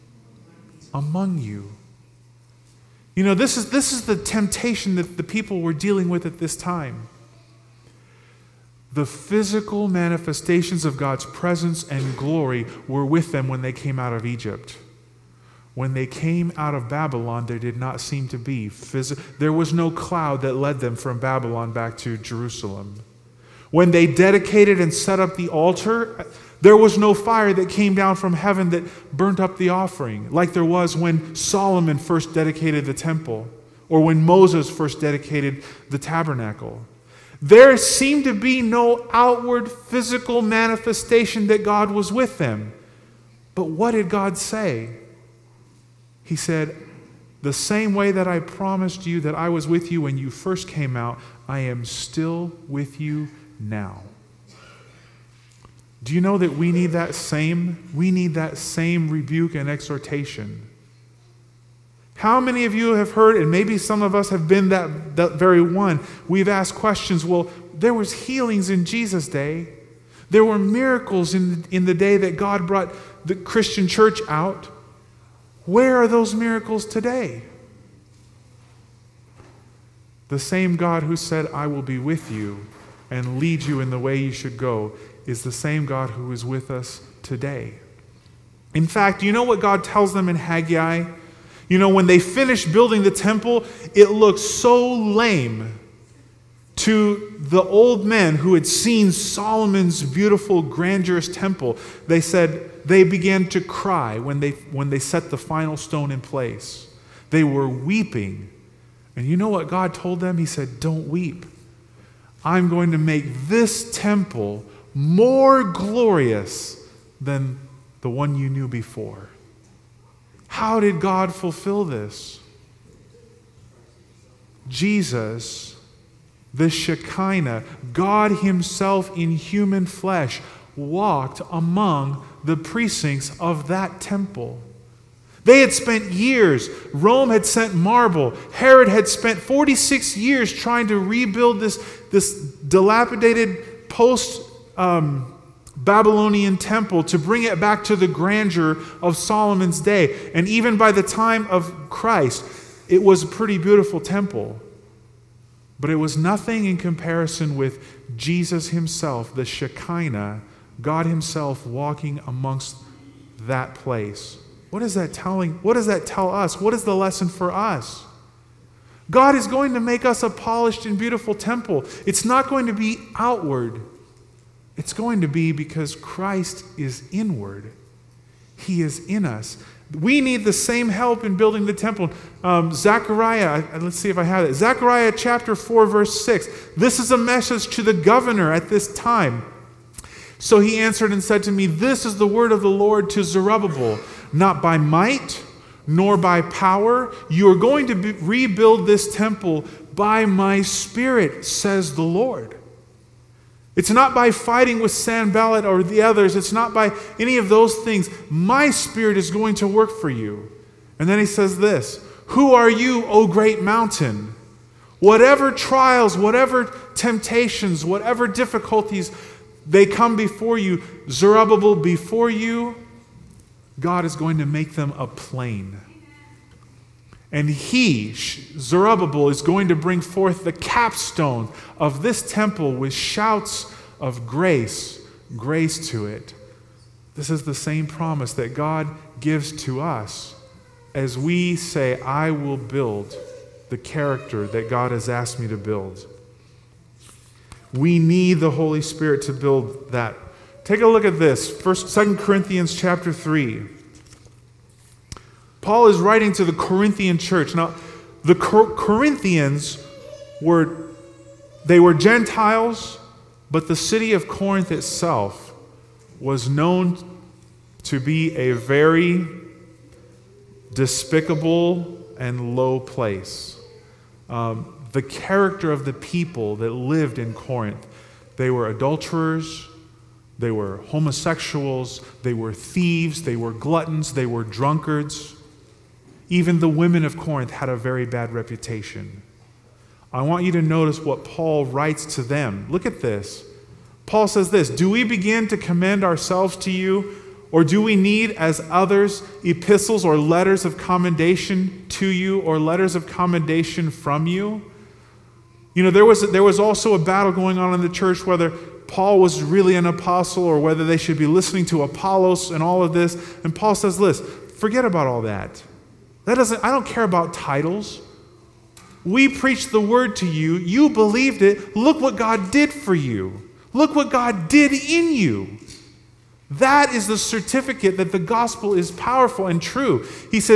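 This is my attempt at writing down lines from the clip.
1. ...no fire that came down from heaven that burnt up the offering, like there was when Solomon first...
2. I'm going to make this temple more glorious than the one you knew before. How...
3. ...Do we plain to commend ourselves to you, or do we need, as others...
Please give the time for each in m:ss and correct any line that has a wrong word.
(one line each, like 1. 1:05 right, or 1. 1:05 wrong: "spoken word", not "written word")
1. 0:26 right
2. 1:52 right
3. 4:54 wrong: "begin", not "plain".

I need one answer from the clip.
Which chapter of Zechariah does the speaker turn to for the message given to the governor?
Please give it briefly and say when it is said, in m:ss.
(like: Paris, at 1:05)
Chapter 4, at 3:04.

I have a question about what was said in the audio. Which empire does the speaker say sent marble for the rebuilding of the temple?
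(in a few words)
Rome.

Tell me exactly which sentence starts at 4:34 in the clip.
Um, the character of the people that lived in Corinth.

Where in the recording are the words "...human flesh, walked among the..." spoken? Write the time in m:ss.
2:09.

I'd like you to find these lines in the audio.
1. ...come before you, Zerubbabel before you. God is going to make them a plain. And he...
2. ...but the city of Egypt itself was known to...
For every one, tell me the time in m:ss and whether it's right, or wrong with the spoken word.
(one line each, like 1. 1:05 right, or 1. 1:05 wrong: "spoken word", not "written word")
1. 3:39 right
2. 4:23 wrong: "Corinth", not "Egypt".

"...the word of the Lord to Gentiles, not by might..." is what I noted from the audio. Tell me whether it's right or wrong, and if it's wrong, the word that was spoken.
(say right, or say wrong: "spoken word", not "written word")
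wrong: "Zerubbabel", not "Gentiles".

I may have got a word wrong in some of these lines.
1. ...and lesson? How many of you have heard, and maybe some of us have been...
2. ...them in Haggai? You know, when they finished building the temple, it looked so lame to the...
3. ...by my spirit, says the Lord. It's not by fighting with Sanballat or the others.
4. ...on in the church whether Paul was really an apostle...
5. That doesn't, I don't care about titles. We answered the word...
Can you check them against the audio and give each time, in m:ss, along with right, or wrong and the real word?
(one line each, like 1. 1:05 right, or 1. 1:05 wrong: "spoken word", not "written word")
1. 0:59 wrong: "exhortation", not "lesson"
2. 1:30 right
3. 3:19 right
4. 5:07 right
5. 5:16 wrong: "preached", not "answered".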